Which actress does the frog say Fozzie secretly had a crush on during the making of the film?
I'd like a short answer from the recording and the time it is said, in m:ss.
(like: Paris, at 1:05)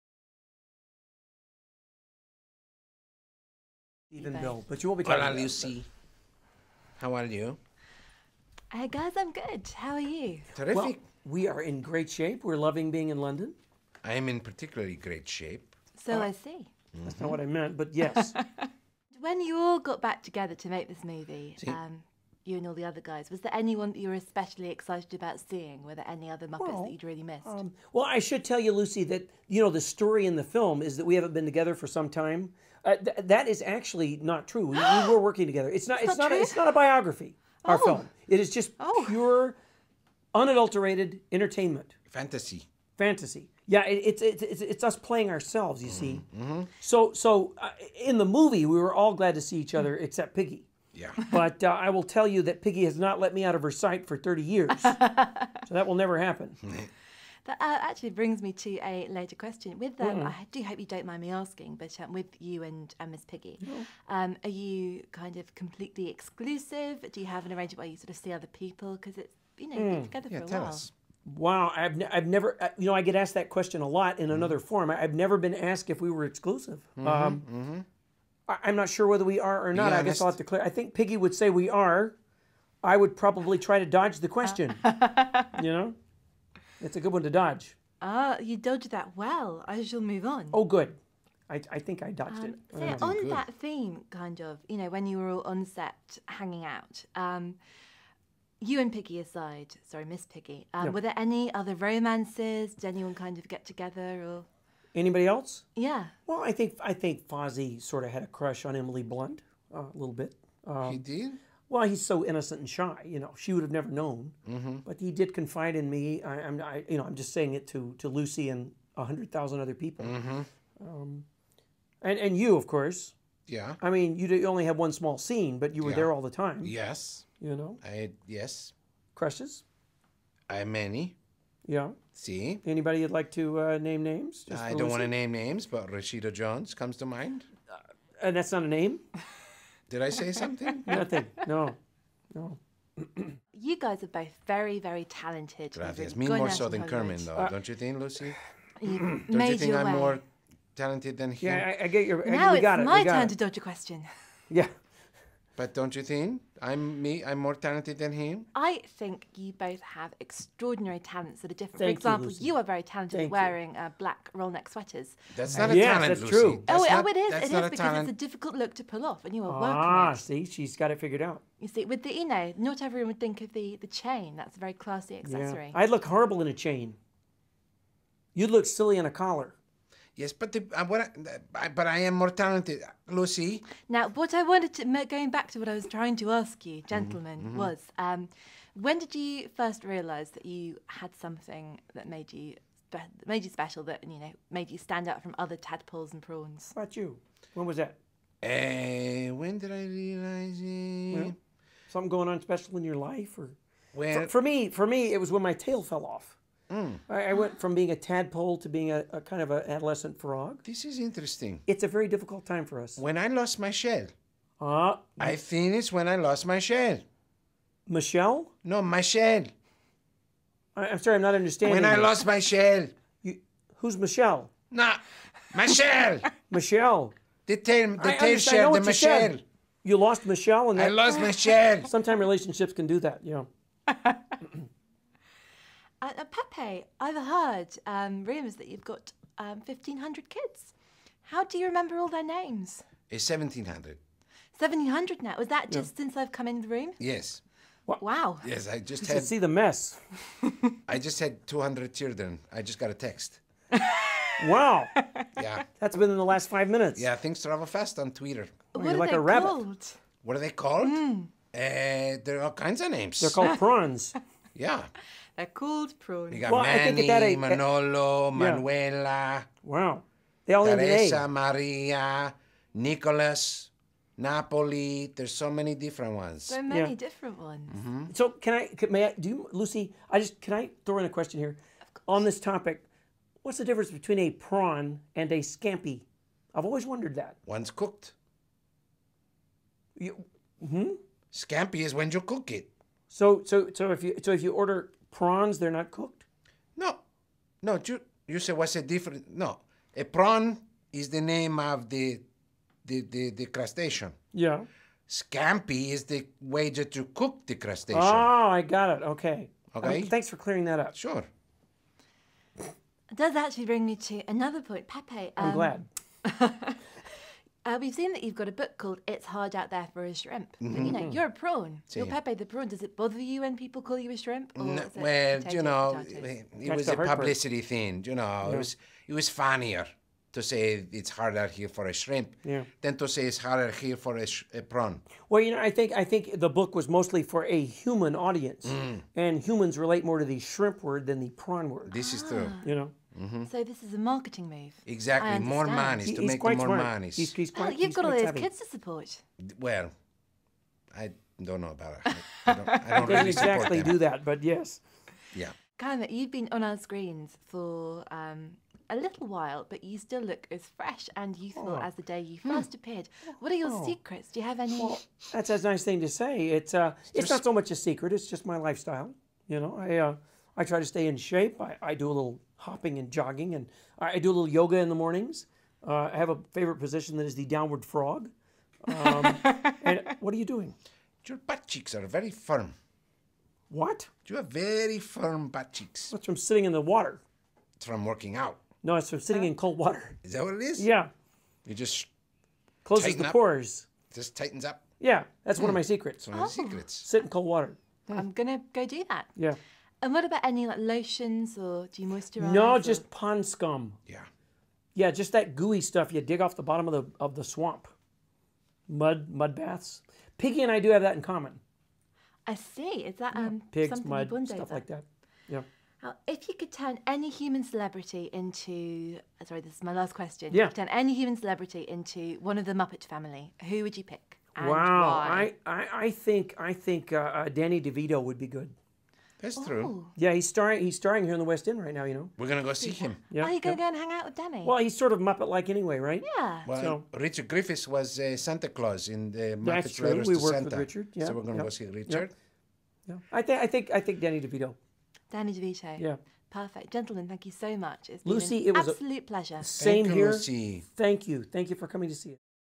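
Emily Blunt, at 1:48.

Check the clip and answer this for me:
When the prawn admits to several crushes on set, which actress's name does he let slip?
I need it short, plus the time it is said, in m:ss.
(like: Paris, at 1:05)
Rashida Jones, at 2:15.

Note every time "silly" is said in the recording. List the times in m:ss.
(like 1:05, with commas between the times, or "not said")
2:58.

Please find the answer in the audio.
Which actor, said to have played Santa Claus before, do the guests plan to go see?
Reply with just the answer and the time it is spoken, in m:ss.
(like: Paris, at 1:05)
Richard Griffiths, at 7:17.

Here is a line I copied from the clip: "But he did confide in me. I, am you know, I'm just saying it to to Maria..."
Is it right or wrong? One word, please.
wrong.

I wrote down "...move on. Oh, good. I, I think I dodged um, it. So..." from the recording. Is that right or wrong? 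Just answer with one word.
right.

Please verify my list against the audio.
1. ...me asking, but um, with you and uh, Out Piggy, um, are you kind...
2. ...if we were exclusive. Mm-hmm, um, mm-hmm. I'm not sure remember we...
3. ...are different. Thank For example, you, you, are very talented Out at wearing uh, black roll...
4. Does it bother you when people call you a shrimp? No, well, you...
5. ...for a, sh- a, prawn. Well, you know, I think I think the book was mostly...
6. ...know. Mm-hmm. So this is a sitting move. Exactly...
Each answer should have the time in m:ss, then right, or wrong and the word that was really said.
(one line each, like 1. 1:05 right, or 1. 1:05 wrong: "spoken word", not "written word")
1. 1:01 wrong: "Miss", not "Out"
2. 1:15 wrong: "whether", not "remember"
3. 2:41 wrong: "Thank", not "Out"
4. 5:22 right
5. 5:33 right
6. 5:42 wrong: "marketing", not "sitting".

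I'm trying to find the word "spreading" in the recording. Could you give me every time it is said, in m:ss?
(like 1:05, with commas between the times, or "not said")
not said.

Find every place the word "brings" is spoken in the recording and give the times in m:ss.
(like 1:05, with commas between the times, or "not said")
0:58, 5:13.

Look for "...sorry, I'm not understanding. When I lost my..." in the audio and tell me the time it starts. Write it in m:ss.
3:40.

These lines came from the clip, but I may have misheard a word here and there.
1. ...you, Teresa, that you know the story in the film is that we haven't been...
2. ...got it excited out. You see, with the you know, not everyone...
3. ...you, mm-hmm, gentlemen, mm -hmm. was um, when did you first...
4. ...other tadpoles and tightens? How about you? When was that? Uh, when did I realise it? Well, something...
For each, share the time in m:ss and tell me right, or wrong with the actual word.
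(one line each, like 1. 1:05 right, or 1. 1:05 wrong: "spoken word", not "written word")
1. 0:28 wrong: "Lucy", not "Teresa"
2. 2:50 wrong: "figured", not "excited"
3. 3:06 right
4. 3:15 wrong: "prawns", not "tightens".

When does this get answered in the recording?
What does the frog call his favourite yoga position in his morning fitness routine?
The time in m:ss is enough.
6:17.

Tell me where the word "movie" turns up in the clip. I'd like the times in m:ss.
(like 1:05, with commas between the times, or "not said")
0:21, 0:48.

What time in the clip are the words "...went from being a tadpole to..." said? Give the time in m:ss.
3:27.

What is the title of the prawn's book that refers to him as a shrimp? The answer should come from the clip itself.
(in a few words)
It's Hard Out There for a Shrimp.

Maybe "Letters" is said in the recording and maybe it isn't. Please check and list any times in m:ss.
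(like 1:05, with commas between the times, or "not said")
7:20.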